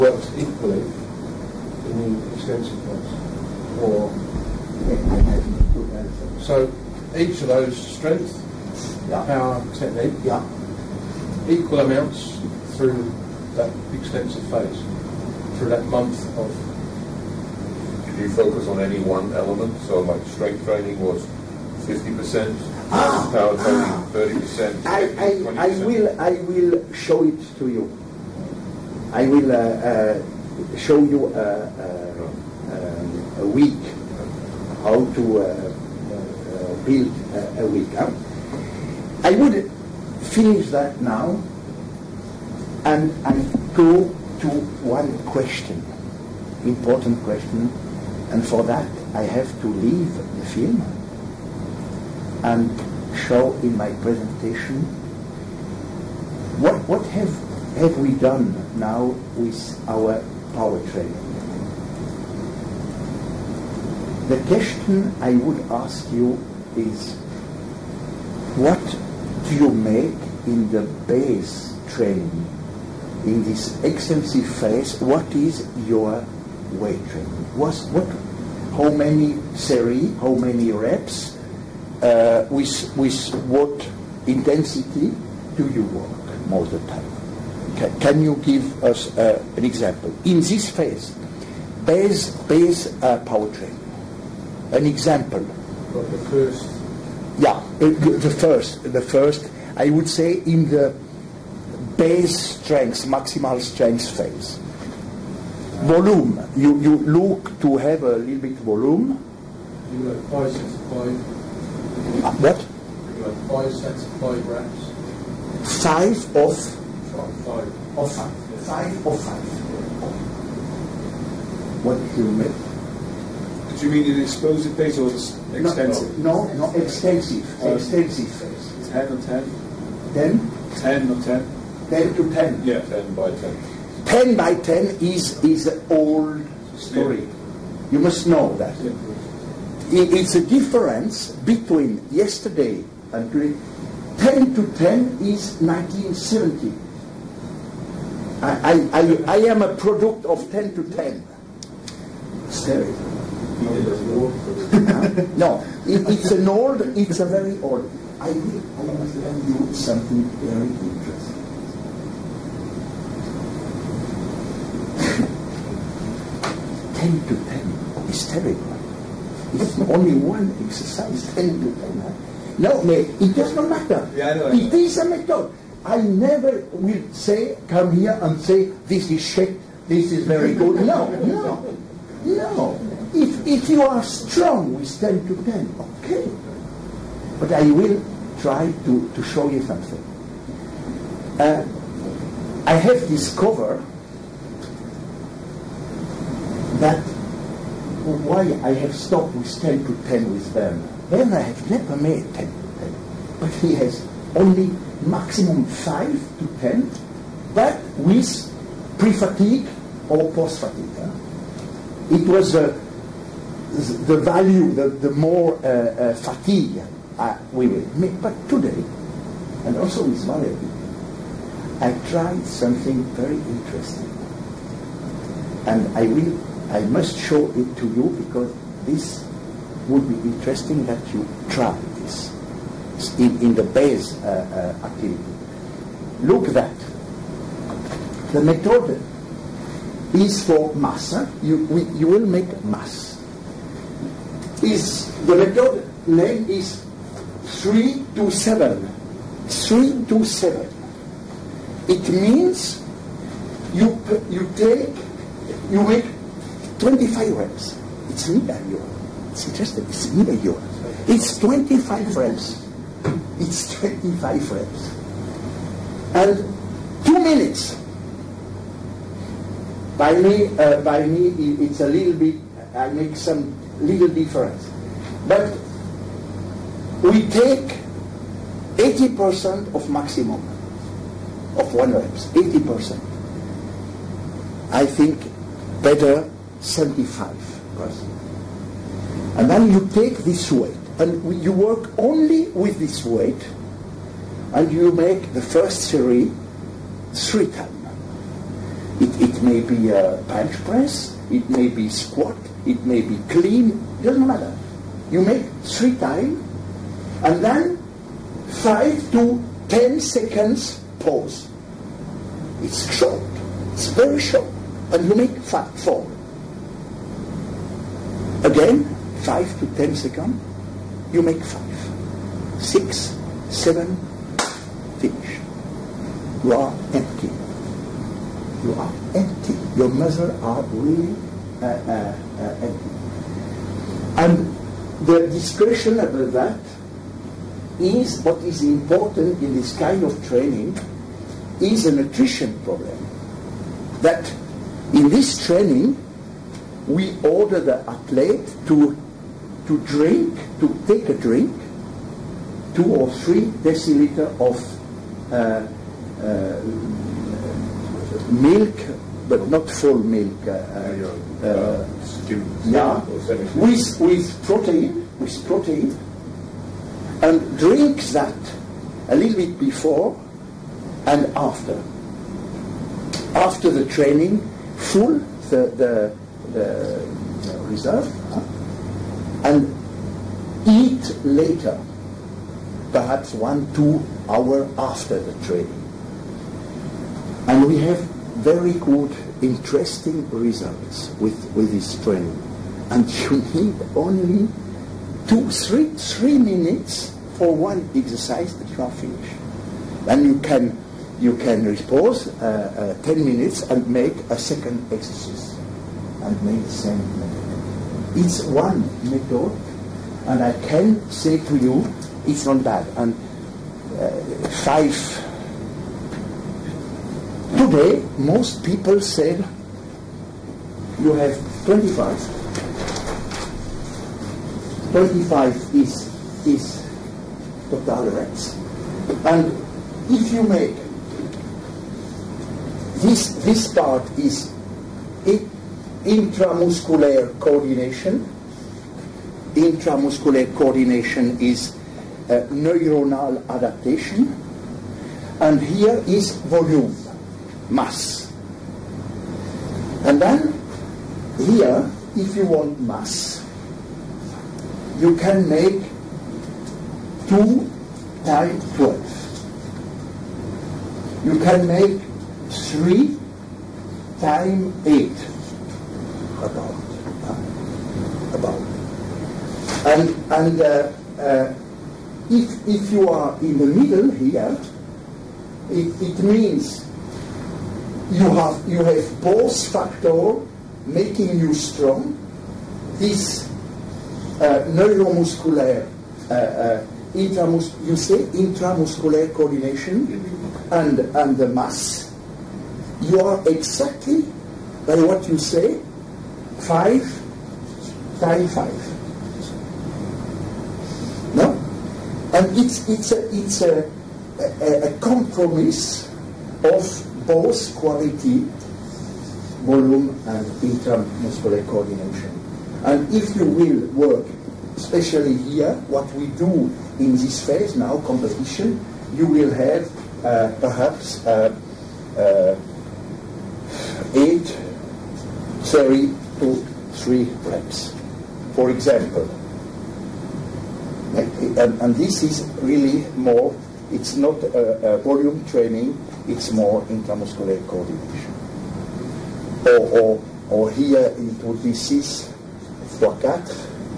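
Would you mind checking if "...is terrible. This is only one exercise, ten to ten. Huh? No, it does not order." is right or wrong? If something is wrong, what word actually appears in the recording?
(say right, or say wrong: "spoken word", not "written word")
wrong: "matter", not "order".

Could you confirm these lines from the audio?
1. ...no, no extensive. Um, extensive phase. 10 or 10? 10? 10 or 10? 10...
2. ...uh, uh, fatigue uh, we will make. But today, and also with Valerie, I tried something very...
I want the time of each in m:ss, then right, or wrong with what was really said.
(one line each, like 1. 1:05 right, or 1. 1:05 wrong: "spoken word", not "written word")
1. 2:06 right
2. 3:35 right.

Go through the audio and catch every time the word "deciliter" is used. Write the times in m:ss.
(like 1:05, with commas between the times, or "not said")
5:53.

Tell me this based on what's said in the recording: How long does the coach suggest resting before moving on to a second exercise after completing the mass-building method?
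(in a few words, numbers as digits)
10 minutes.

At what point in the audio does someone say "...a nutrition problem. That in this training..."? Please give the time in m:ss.
5:41.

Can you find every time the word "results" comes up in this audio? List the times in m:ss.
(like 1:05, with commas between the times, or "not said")
6:30.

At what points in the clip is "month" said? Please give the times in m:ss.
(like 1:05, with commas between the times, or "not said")
0:15.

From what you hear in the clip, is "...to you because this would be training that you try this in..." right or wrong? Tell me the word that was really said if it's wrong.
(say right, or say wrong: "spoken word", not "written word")
wrong: "interesting", not "training".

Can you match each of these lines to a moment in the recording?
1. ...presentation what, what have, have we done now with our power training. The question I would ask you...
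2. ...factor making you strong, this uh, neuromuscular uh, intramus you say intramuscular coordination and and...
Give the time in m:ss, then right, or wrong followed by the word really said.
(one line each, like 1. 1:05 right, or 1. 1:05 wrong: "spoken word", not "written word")
1. 0:54 right
2. 7:59 right.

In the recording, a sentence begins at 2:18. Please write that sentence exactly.
Yeah it's a difference between yesterday and today.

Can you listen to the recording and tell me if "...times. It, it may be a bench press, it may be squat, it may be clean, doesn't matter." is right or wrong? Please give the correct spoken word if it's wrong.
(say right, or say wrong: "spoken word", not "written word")
right.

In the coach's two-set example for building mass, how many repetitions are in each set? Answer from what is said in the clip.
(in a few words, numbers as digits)
12.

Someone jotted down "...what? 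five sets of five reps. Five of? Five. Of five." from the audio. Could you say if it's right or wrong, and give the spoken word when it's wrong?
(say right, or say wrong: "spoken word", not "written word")
right.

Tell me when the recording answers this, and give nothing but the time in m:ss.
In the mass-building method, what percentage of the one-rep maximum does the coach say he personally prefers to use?
4:46.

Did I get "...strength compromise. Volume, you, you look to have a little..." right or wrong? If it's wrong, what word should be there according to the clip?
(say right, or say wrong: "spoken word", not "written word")
wrong: "phase", not "compromise".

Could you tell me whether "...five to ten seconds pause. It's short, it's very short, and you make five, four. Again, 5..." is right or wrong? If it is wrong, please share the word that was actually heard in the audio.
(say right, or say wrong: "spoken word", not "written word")
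right.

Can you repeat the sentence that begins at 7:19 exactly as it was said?
Intramuscular coordination is uh, neuronal adaptation.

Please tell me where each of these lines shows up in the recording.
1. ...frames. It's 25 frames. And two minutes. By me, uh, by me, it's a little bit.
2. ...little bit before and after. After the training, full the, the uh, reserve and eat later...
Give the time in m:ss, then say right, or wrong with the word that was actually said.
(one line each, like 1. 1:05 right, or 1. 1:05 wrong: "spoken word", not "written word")
1. 4:22 right
2. 6:09 right.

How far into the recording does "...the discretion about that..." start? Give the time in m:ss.
5:35.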